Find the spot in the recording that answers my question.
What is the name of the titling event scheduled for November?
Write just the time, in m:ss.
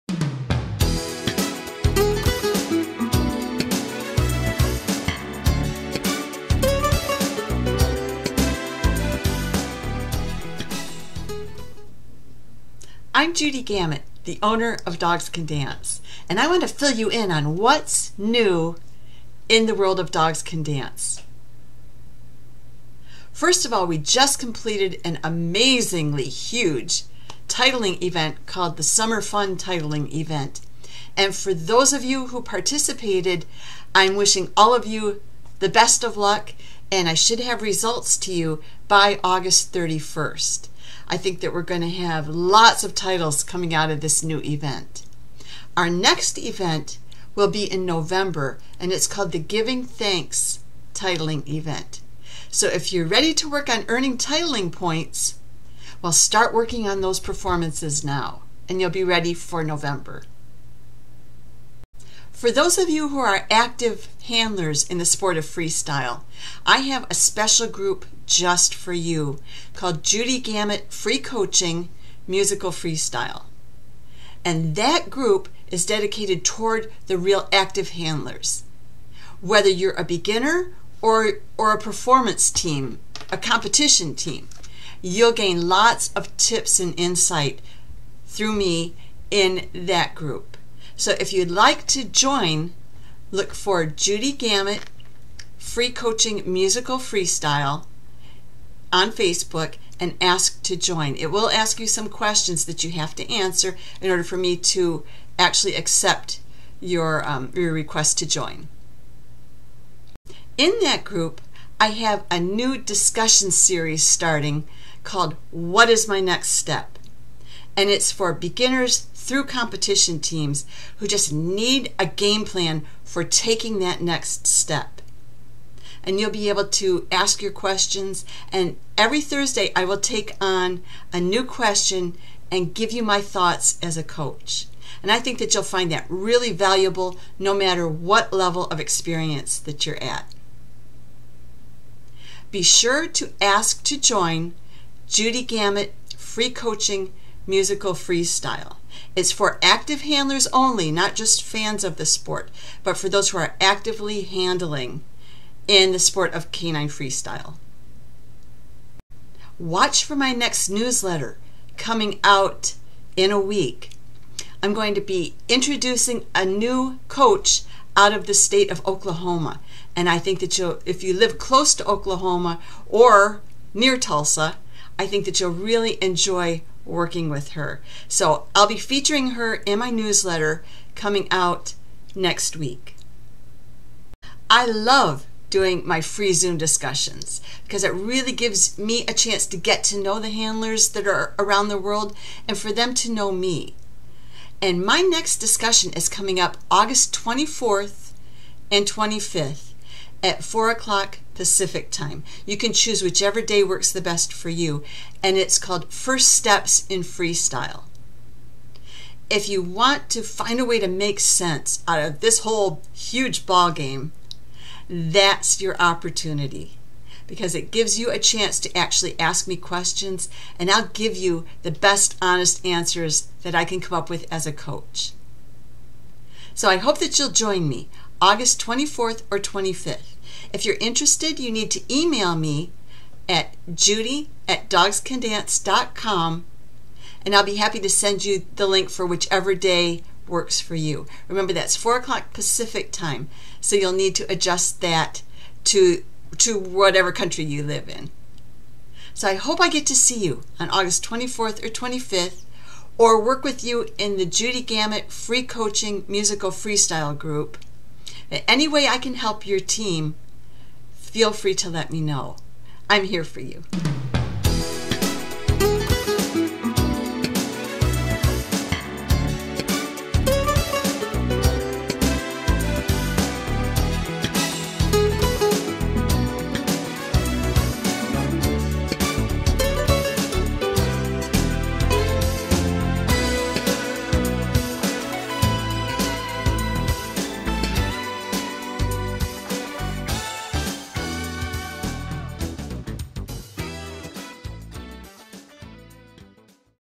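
0:49.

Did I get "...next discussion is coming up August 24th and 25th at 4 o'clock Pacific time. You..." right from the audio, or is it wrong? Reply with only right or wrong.
right.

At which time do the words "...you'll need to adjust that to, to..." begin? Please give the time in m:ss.
4:03.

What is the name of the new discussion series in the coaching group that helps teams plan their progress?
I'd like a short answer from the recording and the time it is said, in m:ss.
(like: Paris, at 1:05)
What is My Next Step?, at 1:55.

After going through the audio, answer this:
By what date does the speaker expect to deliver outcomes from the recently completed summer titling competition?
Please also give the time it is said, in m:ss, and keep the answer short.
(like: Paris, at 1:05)
August 31st, at 0:39.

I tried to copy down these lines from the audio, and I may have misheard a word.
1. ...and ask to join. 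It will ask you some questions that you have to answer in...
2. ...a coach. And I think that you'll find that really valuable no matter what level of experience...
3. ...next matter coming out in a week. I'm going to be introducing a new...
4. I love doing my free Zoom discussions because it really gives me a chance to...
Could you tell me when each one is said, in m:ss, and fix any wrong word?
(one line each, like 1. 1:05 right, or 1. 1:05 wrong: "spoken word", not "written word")
1. 1:39 right
2. 2:13 right
3. 2:40 wrong: "newsletter", not "matter"
4. 3:04 right.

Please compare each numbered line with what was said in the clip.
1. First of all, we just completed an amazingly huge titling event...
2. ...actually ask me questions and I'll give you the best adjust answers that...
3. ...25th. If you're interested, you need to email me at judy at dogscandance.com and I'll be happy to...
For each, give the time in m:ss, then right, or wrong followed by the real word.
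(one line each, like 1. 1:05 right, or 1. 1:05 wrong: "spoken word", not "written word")
1. 0:23 right
2. 3:38 wrong: "honest", not "adjust"
3. 3:49 right.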